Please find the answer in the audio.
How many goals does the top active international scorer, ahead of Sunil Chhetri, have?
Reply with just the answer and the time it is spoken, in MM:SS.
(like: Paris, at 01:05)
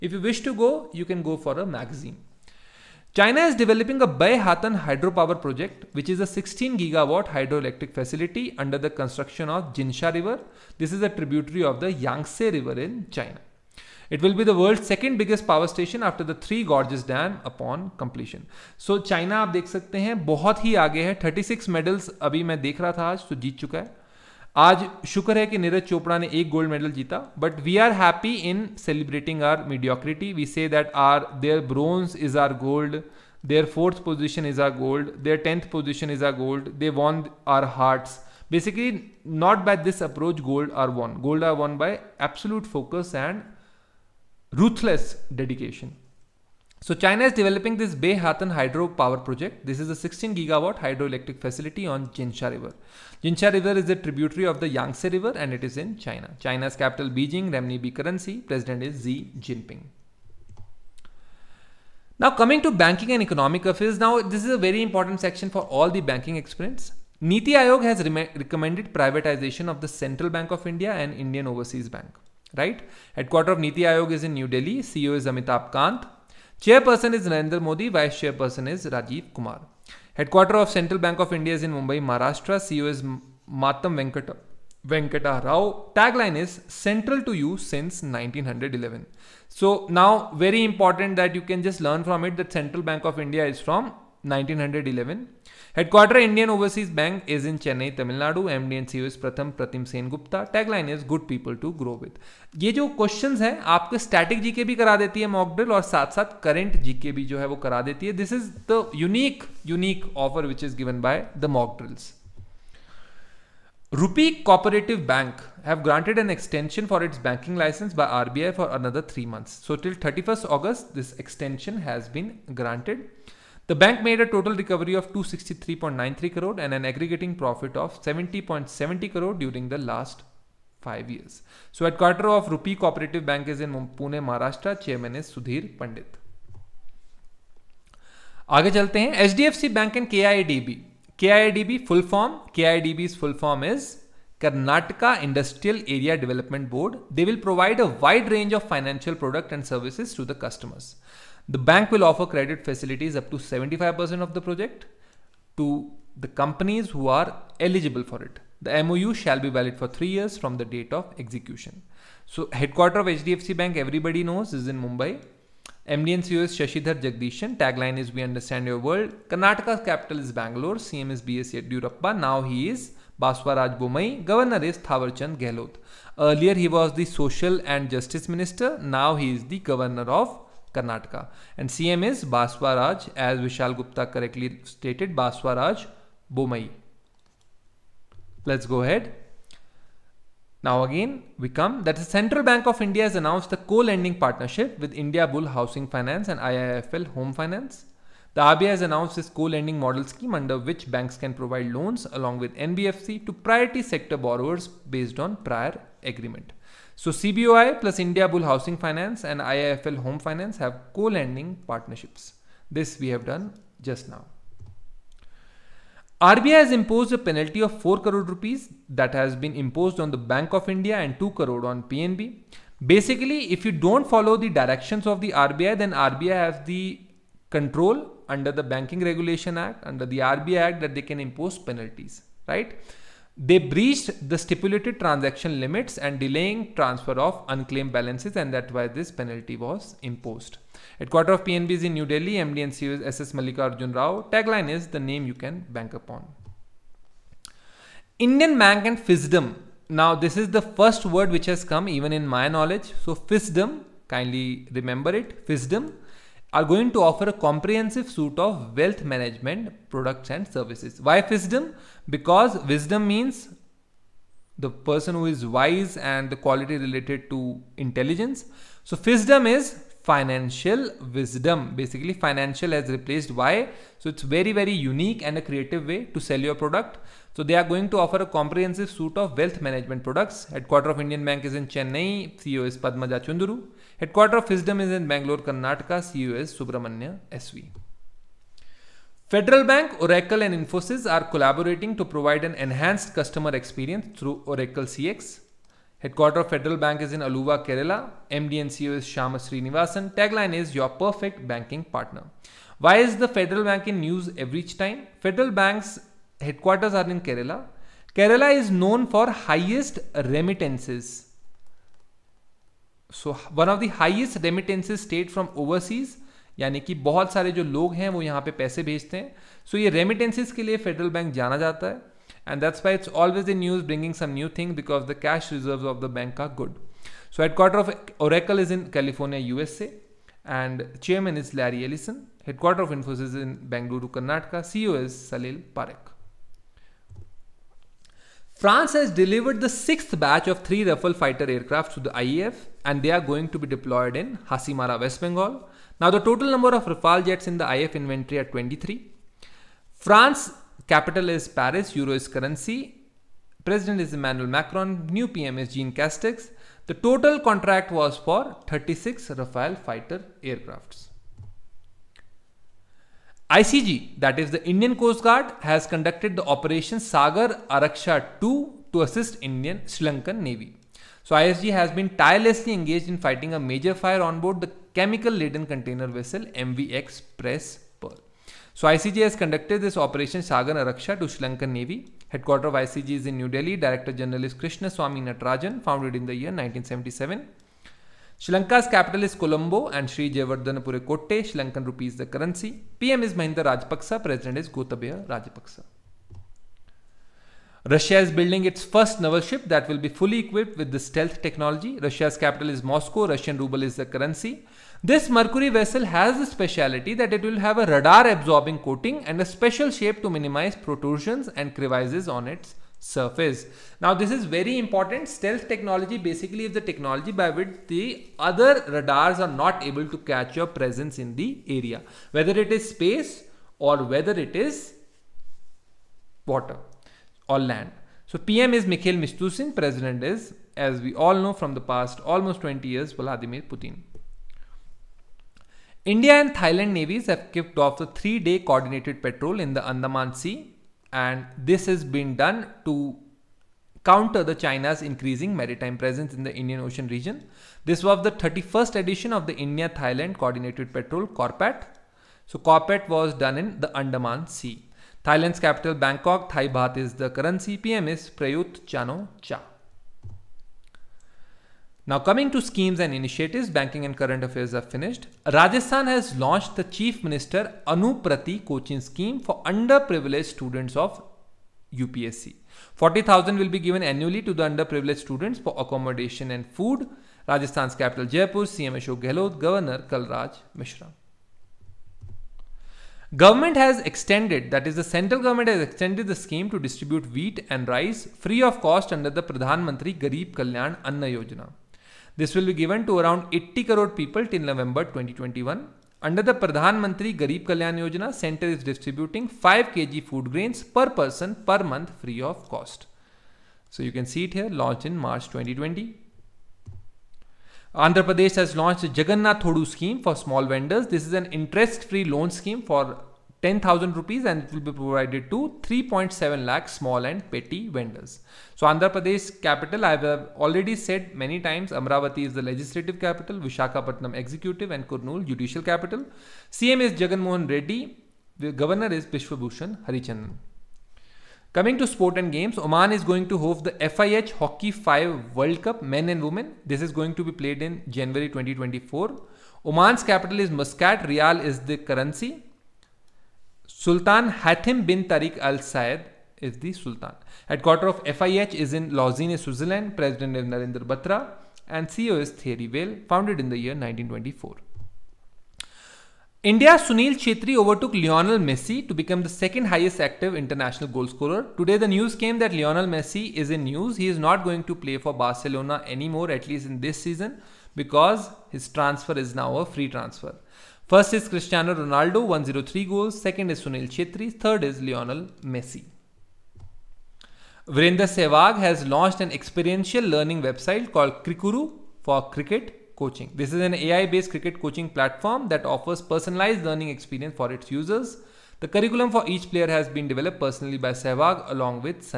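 103, at 09:32.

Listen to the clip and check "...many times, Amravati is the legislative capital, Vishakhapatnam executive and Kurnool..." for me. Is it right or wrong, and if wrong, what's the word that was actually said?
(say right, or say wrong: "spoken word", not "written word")
right.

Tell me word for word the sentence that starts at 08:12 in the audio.
This will be given to around 80 crore people till November 2021.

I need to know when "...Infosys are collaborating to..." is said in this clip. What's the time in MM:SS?
04:50.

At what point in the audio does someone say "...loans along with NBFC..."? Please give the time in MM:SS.
03:21.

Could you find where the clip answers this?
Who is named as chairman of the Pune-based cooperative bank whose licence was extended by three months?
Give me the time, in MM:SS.
02:15.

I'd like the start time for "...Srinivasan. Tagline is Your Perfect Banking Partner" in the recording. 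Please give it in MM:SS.
04:59.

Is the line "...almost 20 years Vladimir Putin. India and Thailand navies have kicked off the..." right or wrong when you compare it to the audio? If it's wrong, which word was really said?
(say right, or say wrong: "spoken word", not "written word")
right.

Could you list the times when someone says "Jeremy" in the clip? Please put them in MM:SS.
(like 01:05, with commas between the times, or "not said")
not said.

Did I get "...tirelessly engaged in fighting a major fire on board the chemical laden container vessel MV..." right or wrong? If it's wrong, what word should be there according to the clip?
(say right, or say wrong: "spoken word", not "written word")
right.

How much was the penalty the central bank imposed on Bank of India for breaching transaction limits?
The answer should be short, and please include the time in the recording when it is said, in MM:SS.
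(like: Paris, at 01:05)
4 crore rupees, at 03:37.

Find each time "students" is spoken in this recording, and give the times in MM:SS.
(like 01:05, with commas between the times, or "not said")
07:50, 07:55.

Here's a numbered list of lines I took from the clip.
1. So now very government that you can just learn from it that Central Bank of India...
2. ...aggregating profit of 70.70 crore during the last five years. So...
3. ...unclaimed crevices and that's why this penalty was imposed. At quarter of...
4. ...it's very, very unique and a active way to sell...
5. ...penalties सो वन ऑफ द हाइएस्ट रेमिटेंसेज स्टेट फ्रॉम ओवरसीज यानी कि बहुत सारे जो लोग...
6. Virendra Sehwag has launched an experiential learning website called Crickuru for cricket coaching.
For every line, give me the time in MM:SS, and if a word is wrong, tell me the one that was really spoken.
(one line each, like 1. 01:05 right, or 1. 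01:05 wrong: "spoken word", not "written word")
1. 01:29 wrong: "important", not "government"
2. 02:06 right
3. 03:57 wrong: "balances", not "crevices"
4. 04:34 wrong: "creative", not "active"
5. 05:10 wrong: "remittances", not "penalties"
6. 09:37 right.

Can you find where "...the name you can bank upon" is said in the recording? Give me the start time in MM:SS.
04:04.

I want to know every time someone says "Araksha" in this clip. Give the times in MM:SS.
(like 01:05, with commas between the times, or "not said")
06:07, 06:20.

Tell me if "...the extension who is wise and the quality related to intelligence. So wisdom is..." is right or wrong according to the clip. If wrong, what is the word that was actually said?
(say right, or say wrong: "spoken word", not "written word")
wrong: "person", not "extension".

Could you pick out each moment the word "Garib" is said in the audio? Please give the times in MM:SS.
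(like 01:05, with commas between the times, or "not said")
08:10, 08:17.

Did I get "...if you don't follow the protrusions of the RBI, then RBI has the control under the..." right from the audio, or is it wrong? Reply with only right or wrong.
wrong.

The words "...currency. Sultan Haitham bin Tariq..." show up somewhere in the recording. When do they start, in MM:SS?
09:01.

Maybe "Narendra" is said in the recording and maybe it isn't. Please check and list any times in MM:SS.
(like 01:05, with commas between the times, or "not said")
01:17, 09:10.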